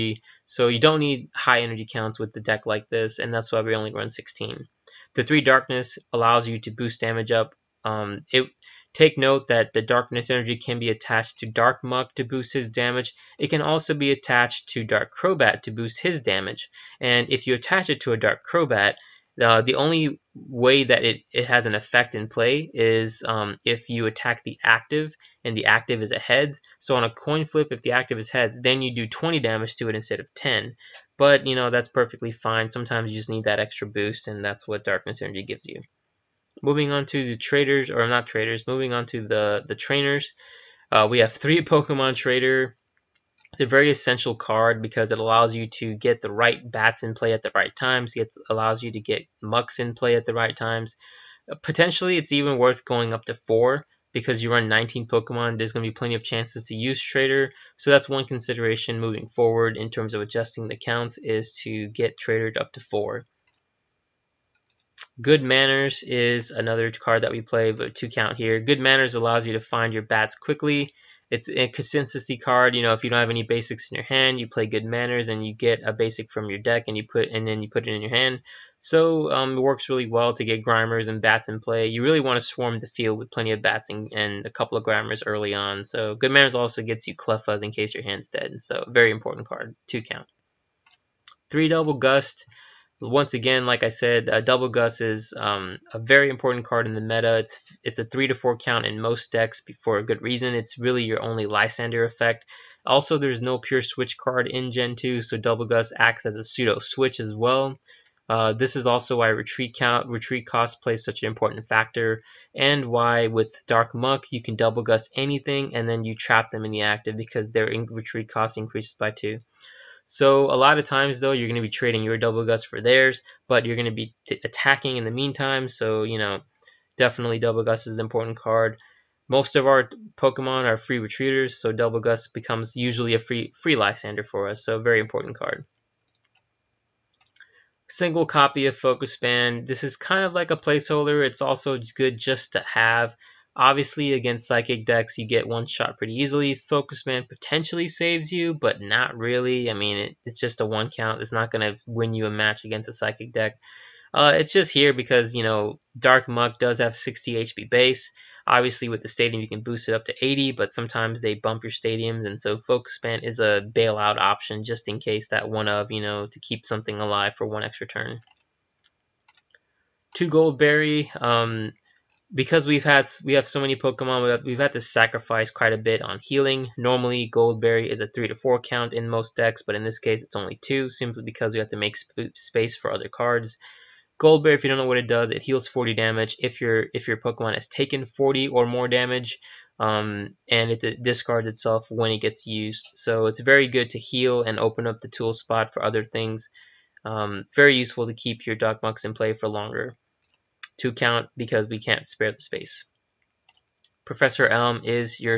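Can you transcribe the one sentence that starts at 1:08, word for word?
Good Manners allows you to find your bats quickly.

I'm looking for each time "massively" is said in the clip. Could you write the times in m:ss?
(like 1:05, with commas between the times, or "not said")
not said.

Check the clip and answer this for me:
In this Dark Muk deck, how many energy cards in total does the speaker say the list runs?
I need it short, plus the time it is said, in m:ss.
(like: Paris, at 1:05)
16, at 0:04.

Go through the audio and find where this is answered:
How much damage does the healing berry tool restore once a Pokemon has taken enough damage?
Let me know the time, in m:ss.
3:05.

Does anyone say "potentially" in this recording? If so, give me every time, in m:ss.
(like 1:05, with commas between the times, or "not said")
0:51, 2:27.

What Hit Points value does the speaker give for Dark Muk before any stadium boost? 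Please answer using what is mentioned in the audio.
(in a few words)
60.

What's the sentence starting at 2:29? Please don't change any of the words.
I mean, it, it's just a one count.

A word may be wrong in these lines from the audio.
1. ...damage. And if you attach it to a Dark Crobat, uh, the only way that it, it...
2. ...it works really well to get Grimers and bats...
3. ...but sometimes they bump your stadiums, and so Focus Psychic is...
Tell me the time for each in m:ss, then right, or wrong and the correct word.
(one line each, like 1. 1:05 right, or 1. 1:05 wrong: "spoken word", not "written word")
1. 0:16 right
2. 1:19 right
3. 2:40 wrong: "Band", not "Psychic".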